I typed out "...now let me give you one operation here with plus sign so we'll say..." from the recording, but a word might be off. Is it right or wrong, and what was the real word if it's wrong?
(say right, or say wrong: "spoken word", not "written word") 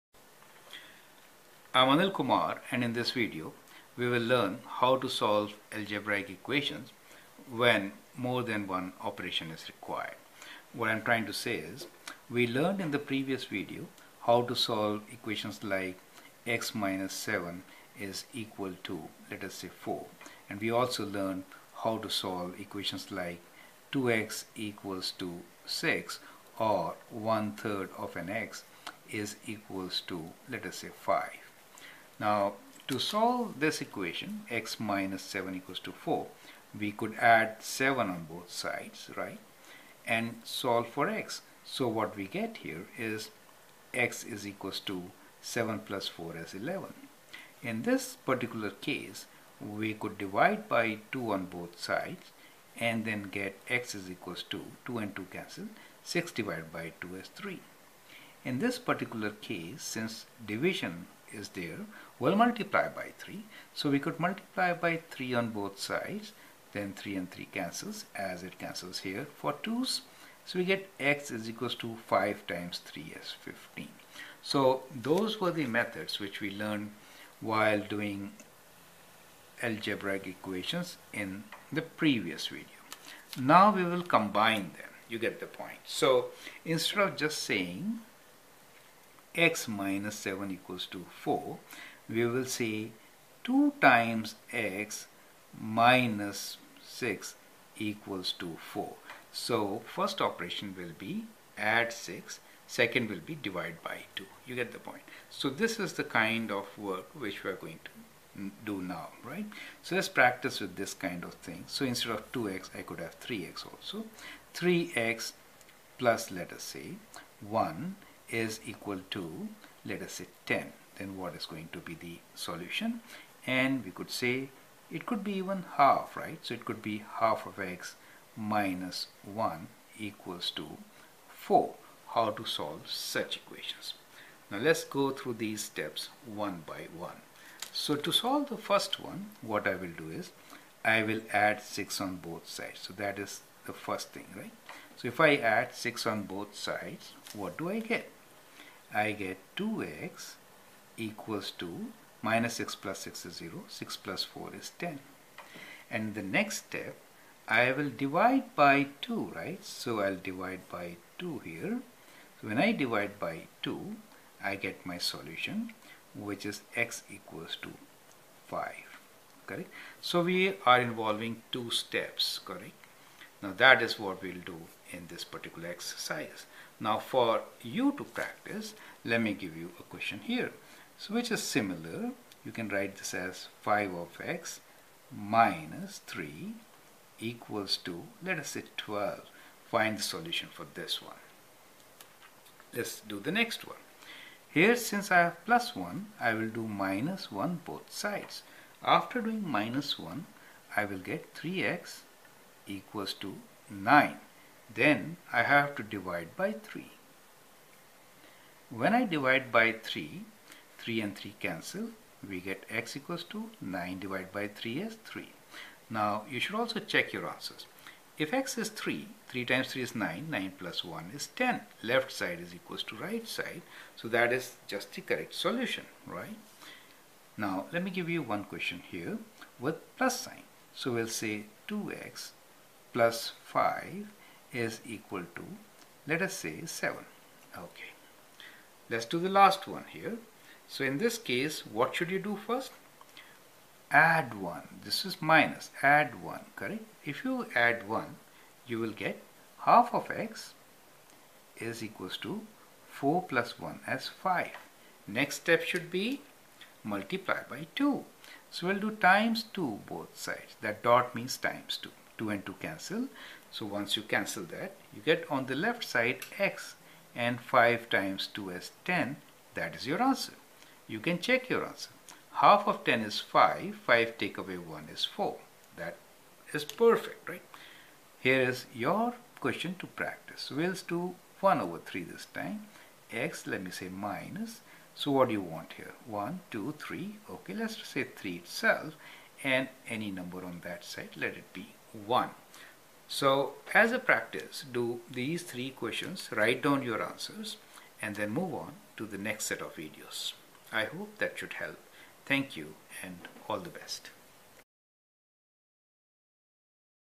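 wrong: "question", not "operation".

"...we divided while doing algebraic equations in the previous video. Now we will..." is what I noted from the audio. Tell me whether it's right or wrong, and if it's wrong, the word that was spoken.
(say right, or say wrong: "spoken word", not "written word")
wrong: "learned", not "divided".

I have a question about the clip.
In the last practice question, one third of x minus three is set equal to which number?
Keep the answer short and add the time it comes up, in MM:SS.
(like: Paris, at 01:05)
1, at 04:51.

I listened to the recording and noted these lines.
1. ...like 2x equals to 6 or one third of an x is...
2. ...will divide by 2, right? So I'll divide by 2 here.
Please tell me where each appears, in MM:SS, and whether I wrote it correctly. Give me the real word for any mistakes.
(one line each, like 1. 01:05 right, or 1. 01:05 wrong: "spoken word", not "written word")
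1. 00:23 right
2. 02:37 right.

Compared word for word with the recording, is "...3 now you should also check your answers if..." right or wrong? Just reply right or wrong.
right.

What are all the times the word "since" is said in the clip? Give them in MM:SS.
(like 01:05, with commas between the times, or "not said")
00:59, 03:14.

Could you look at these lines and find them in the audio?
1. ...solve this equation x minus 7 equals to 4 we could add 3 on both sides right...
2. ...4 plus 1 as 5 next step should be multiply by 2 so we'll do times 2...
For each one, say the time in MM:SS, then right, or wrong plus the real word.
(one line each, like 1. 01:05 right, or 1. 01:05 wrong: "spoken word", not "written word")
1. 00:32 wrong: "7", not "3"
2. 04:12 right.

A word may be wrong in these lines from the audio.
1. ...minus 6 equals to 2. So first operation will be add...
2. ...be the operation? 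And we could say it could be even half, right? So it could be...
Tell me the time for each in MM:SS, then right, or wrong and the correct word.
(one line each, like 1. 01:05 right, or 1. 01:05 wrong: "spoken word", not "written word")
1. 01:35 wrong: "4", not "2"
2. 02:01 wrong: "solution", not "operation".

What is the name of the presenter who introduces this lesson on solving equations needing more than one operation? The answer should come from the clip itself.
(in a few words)
Anil Kumar.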